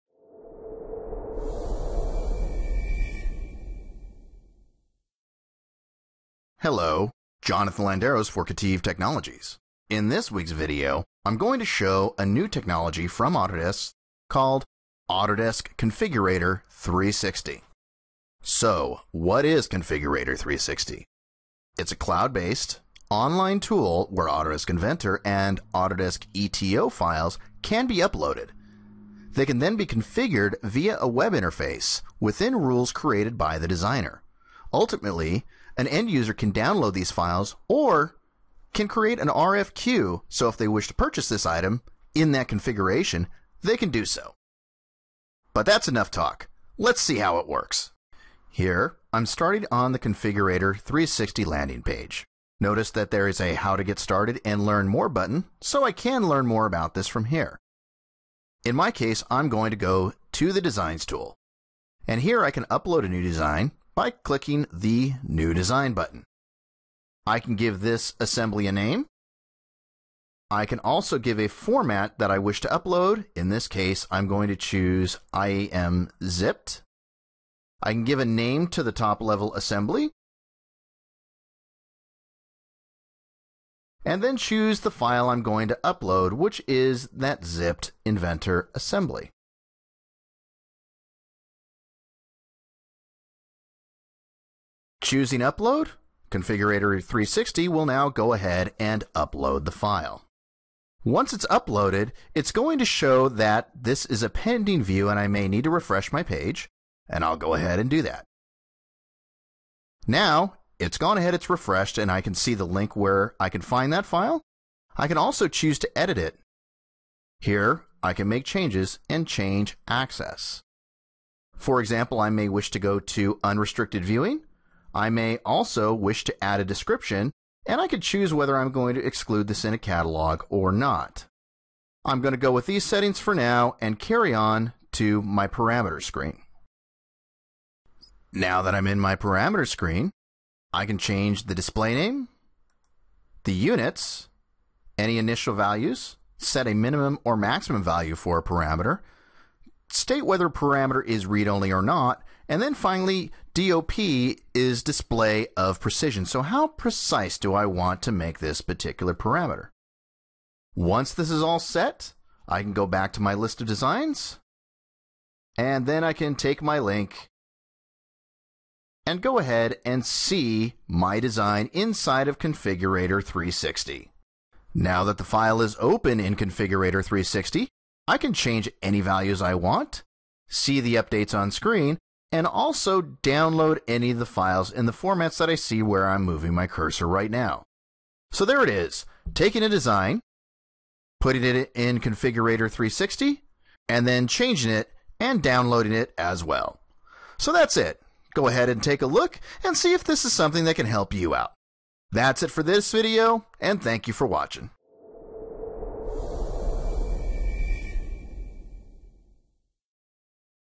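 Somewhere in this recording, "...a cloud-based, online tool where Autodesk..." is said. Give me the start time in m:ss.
0:21.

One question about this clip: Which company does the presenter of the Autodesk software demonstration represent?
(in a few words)
KETIV Technologies.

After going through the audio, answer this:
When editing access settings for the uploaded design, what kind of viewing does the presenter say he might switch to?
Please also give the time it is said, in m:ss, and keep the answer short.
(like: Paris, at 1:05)
Unrestricted viewing, at 2:03.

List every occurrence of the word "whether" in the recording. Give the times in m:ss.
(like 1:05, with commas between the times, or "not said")
2:08, 2:30.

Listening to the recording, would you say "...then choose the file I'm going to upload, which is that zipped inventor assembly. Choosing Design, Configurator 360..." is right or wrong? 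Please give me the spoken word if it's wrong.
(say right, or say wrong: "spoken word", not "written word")
wrong: "Upload", not "Design".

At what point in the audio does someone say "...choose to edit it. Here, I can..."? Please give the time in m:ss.
1:55.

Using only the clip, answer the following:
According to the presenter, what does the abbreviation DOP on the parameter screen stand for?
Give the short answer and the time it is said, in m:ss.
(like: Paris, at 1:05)
Display of precision, at 2:34.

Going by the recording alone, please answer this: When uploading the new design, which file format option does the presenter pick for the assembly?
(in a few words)
IAM zipped.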